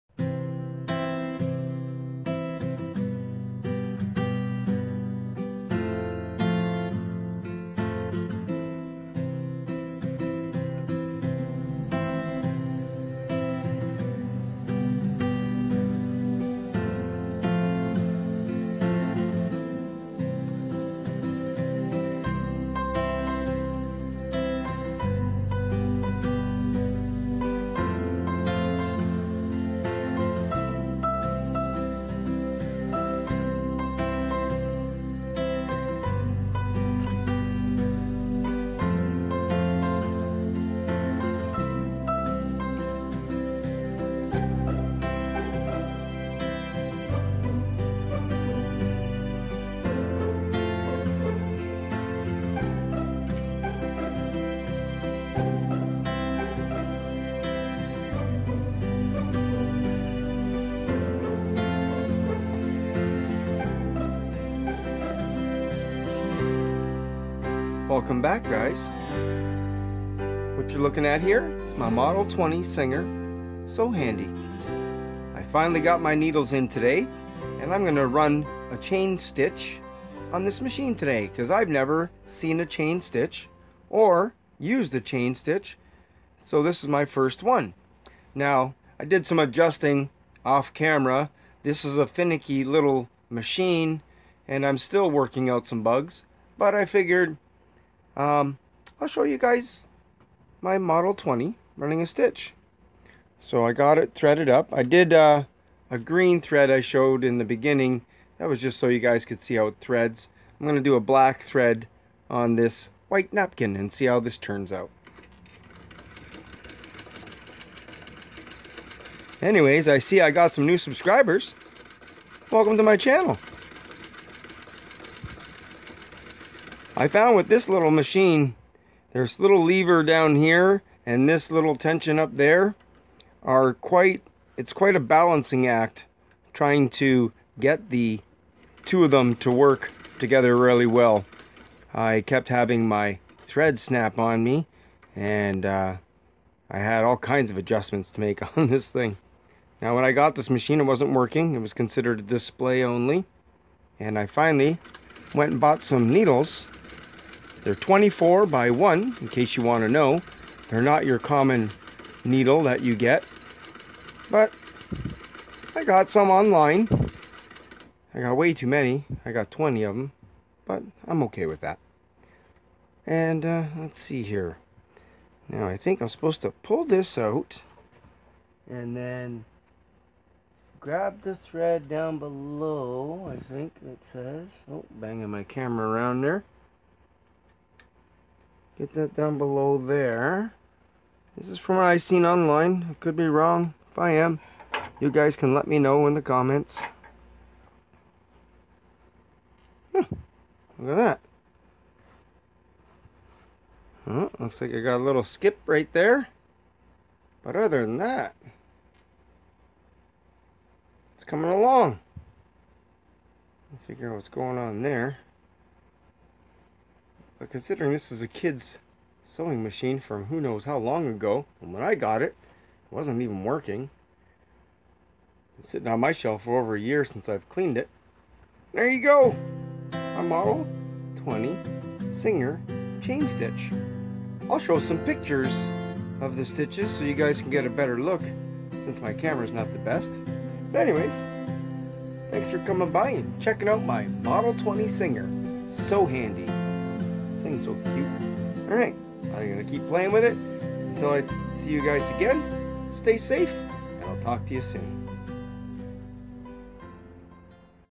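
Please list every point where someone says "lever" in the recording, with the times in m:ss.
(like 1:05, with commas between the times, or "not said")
2:09.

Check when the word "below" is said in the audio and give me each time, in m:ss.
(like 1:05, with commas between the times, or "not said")
3:02, 3:09.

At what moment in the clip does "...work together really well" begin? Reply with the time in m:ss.
2:19.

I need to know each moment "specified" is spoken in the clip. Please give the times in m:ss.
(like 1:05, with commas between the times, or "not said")
not said.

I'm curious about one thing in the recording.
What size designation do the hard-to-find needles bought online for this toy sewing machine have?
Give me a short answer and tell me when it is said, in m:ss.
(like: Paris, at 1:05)
24 by 1, at 2:37.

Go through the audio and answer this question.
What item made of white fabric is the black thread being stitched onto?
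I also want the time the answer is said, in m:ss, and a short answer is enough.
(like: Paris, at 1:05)
napkin, at 1:53.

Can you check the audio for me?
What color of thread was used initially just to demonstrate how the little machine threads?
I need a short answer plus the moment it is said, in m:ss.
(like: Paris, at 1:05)
green, at 1:45.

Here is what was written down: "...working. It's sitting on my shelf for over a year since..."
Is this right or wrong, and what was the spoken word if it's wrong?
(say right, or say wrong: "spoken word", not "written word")
right.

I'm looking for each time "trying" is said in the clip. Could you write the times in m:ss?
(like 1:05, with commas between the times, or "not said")
2:16.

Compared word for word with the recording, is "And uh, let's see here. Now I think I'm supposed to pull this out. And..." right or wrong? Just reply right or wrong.
right.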